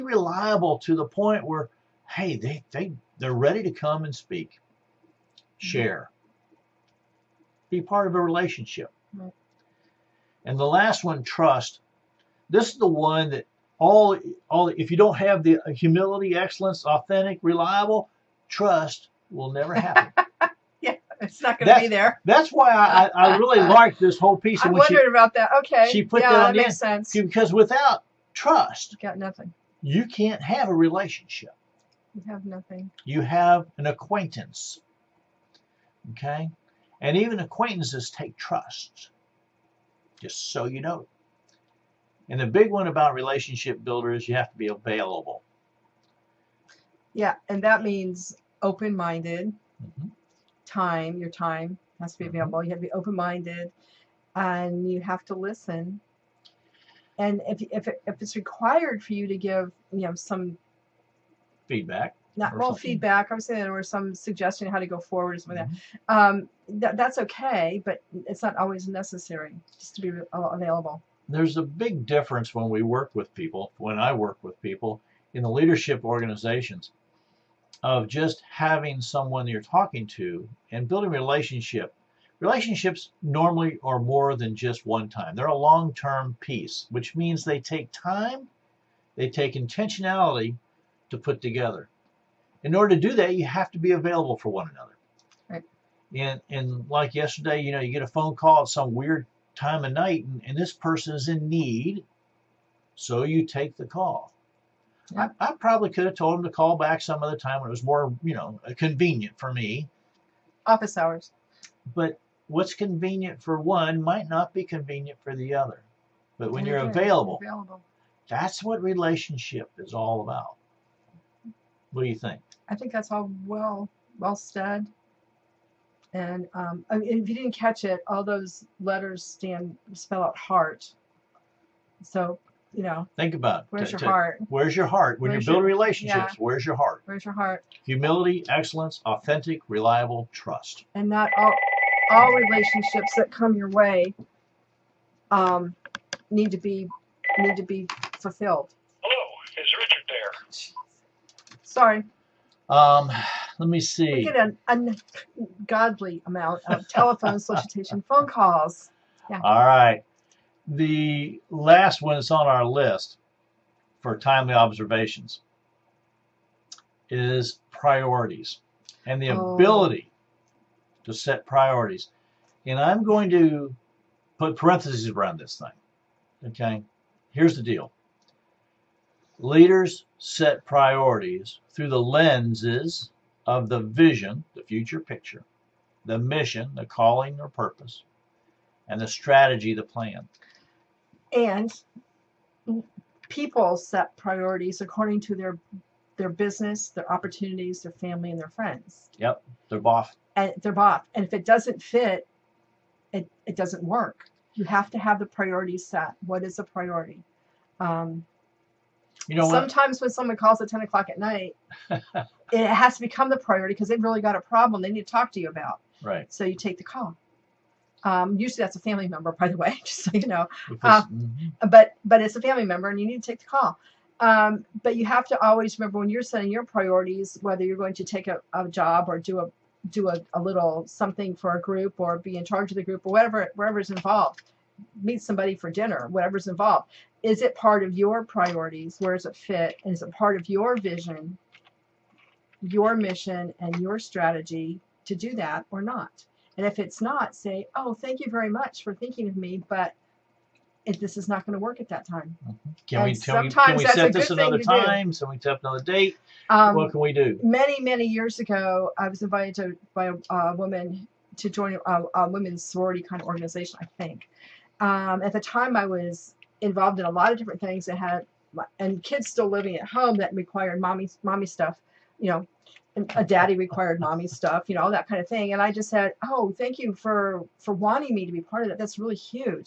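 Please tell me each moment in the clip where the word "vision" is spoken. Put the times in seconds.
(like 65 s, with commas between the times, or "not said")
183 s, 240 s.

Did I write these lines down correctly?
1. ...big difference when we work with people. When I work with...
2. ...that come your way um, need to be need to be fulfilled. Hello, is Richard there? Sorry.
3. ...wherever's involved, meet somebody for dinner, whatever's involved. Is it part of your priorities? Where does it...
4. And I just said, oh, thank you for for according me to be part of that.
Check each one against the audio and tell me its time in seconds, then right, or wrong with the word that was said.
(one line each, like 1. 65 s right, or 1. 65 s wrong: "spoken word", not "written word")
1. 71 s right
2. 143 s right
3. 233 s right
4. 275 s wrong: "wanting", not "according".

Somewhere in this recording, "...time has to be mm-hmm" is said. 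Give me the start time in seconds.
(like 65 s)
51 s.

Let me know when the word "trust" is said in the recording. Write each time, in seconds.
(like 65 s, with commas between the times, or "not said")
11 s, 18 s, 28 s, 38 s, 140 s.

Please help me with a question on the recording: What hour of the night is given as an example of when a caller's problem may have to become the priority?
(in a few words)
10 o'clock.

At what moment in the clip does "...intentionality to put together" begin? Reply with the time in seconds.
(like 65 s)
89 s.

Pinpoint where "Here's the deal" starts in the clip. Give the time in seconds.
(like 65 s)
177 s.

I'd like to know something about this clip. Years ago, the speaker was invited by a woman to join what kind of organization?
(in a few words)
women's sorority.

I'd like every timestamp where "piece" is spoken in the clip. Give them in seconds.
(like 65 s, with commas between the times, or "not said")
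24 s, 86 s.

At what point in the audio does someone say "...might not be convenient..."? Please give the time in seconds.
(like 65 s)
114 s.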